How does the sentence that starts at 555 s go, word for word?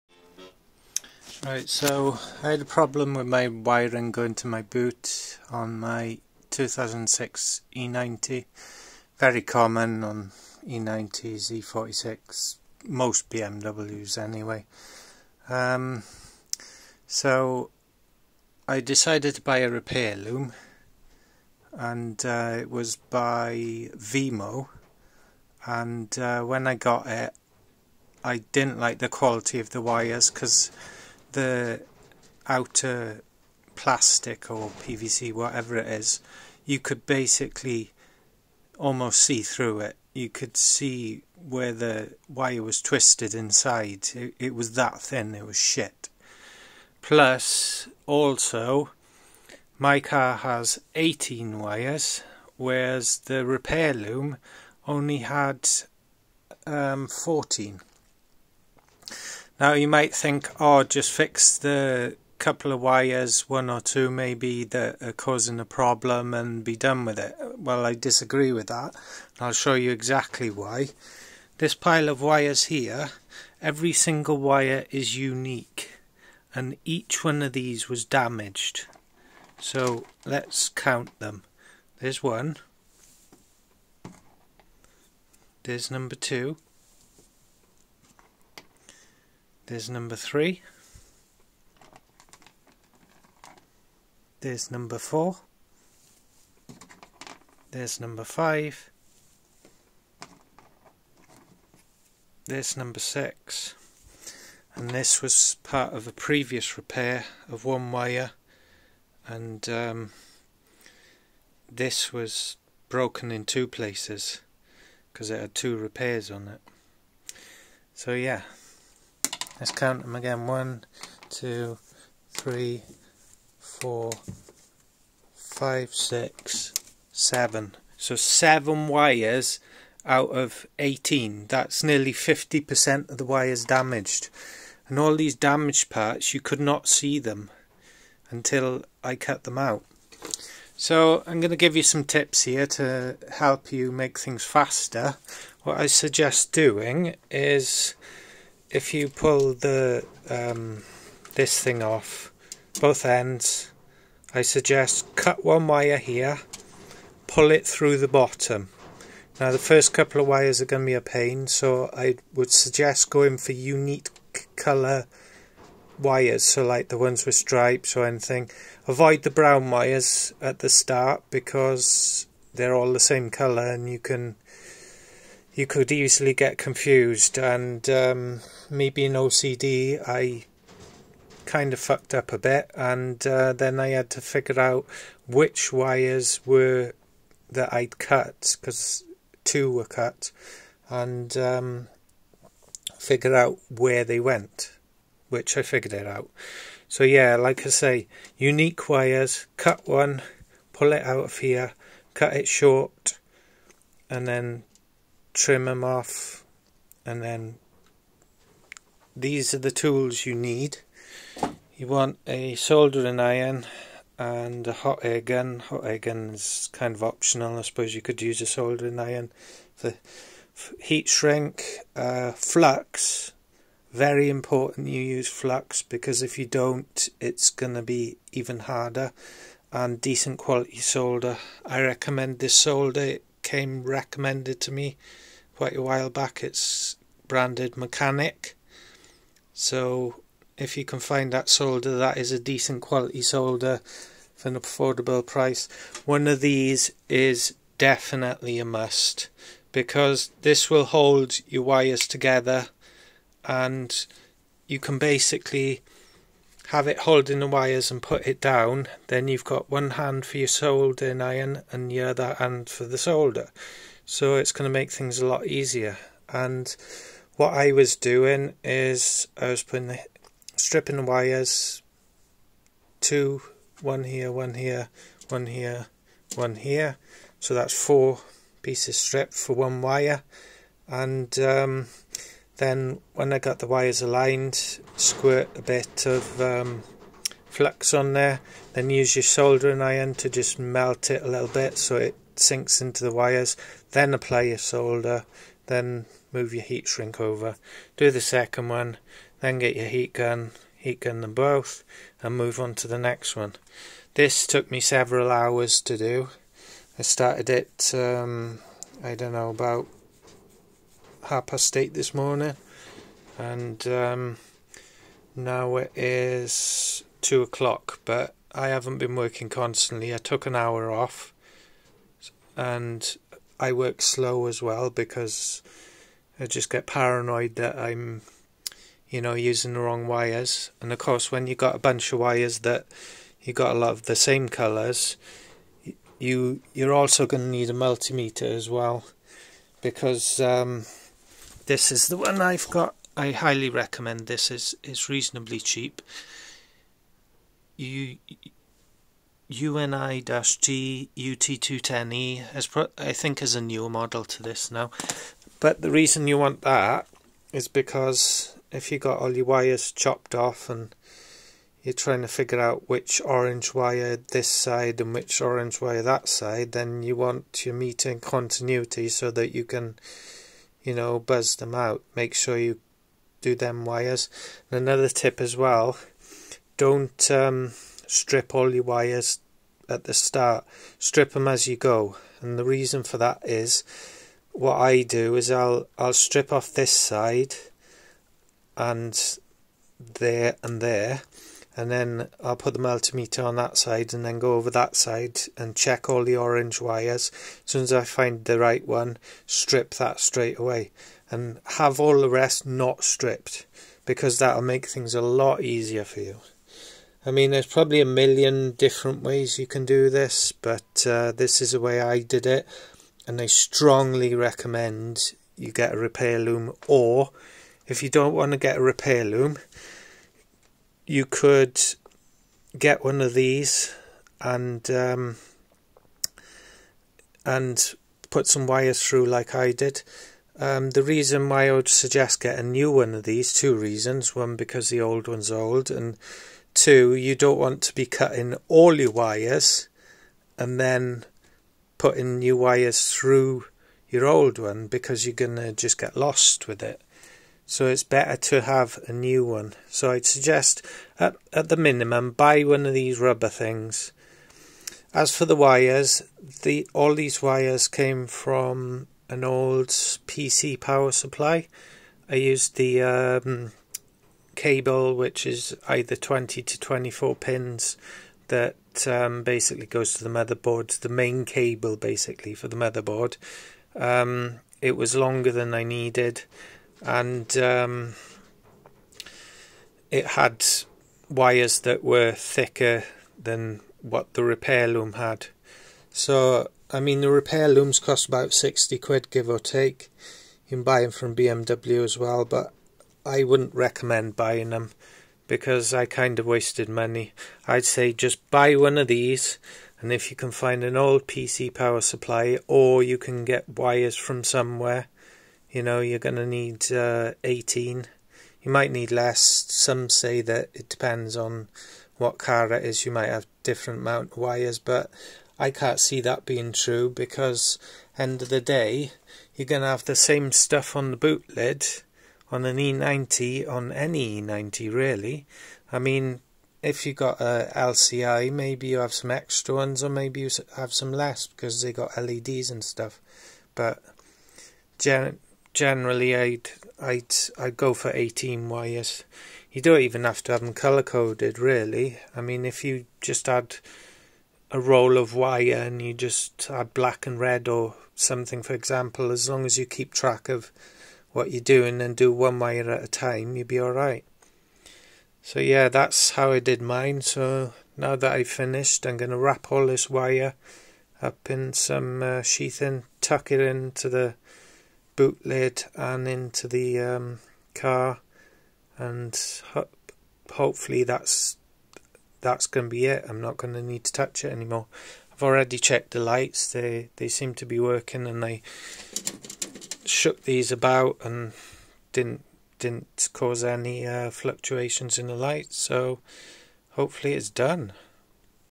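So yeah, that's how I did mine.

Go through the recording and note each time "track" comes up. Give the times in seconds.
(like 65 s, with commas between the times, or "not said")
550 s.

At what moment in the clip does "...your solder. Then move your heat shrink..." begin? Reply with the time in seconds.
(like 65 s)
294 s.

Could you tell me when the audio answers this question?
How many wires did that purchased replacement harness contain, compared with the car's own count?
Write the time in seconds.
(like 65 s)
57 s.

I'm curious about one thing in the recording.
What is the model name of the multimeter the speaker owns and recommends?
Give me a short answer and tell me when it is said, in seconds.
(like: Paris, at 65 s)
UT210E, at 349 s.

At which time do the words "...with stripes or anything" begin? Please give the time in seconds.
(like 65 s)
167 s.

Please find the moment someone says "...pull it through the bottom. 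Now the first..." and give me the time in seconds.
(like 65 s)
157 s.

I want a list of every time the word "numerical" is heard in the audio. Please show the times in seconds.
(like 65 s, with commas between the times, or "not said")
not said.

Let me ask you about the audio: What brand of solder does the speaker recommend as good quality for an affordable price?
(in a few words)
Mechanic.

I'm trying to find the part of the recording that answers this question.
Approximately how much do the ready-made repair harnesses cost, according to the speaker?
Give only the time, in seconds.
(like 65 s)
488 s.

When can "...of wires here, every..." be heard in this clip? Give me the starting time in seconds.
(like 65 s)
72 s.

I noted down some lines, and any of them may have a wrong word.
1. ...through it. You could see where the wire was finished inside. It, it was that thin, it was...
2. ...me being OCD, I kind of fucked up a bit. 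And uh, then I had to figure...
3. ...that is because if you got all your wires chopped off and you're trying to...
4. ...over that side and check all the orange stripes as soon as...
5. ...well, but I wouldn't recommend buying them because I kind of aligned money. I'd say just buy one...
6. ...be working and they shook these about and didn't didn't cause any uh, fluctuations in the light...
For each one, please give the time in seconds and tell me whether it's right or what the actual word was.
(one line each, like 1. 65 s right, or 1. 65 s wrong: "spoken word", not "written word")
1. 39 s wrong: "twisted", not "finished"
2. 178 s right
3. 356 s right
4. 394 s wrong: "wires", not "stripes"
5. 492 s wrong: "wasted", not "aligned"
6. 577 s right.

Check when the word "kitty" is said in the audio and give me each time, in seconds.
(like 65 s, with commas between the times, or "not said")
not said.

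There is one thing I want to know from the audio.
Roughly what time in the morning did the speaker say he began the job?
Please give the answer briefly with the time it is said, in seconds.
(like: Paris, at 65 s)
8:30, at 311 s.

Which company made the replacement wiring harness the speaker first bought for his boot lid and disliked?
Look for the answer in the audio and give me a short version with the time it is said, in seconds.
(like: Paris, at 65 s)
Vemo, at 23 s.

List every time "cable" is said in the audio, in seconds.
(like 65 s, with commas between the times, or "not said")
464 s, 471 s.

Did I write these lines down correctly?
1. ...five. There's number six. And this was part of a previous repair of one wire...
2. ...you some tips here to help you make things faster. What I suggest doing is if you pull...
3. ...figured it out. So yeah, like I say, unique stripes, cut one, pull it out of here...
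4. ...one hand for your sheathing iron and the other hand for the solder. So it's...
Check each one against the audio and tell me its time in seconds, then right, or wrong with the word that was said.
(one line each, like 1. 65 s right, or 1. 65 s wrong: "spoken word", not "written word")
1. 98 s right
2. 141 s right
3. 195 s wrong: "wires", not "stripes"
4. 259 s wrong: "soldering", not "sheathing".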